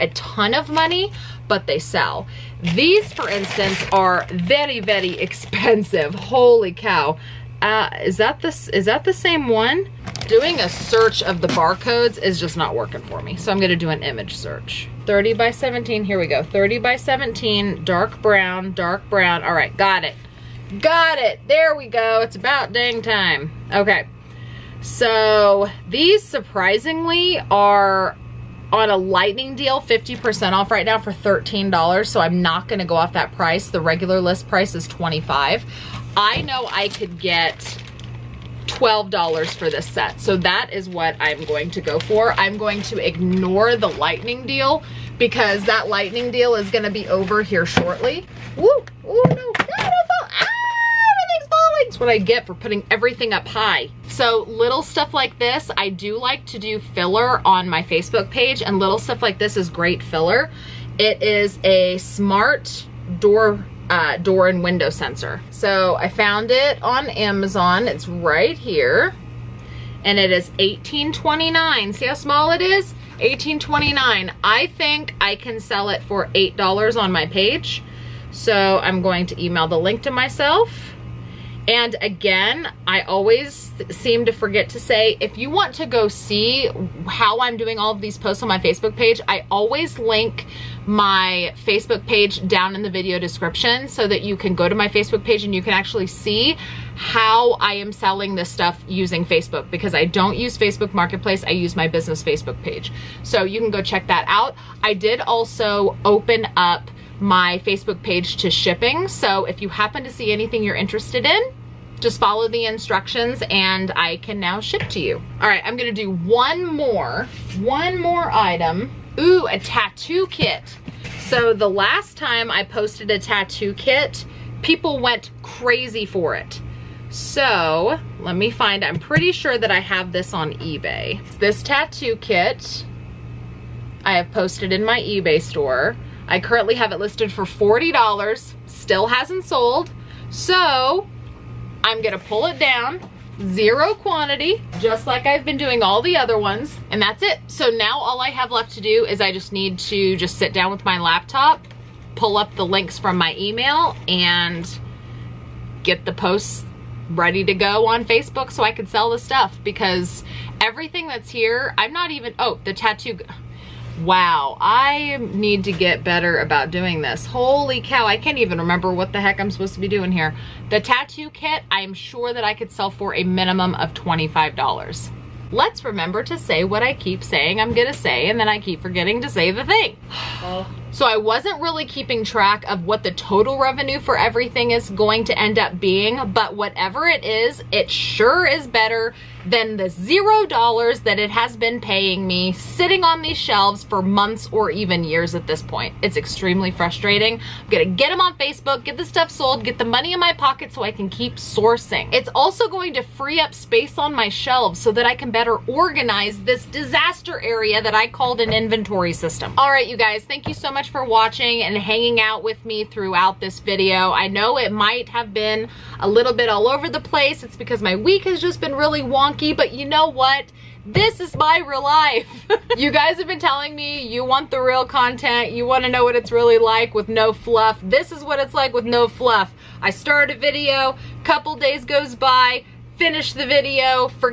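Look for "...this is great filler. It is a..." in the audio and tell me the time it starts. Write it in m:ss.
0:59.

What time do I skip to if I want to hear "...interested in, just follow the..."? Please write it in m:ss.
1:50.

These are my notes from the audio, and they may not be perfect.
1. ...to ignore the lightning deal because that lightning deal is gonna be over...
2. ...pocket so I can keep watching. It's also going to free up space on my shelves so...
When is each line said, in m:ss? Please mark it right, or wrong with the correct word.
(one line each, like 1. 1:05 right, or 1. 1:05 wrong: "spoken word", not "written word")
1. 0:42 right
2. 3:20 wrong: "sourcing", not "watching".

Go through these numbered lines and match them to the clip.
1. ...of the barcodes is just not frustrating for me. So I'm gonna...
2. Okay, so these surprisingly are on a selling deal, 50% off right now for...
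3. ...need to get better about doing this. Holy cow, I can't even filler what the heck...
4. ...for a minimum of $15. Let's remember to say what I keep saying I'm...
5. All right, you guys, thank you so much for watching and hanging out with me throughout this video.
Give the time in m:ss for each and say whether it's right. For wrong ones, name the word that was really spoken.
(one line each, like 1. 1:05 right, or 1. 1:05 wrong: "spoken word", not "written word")
1. 0:11 wrong: "working", not "frustrating"
2. 0:23 wrong: "lightning", not "selling"
3. 2:45 wrong: "remember", not "filler"
4. 2:52 wrong: "25", not "15"
5. 3:29 right.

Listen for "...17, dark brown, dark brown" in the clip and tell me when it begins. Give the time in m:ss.
0:16.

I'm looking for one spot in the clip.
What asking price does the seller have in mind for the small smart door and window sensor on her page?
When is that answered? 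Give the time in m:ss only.
1:16.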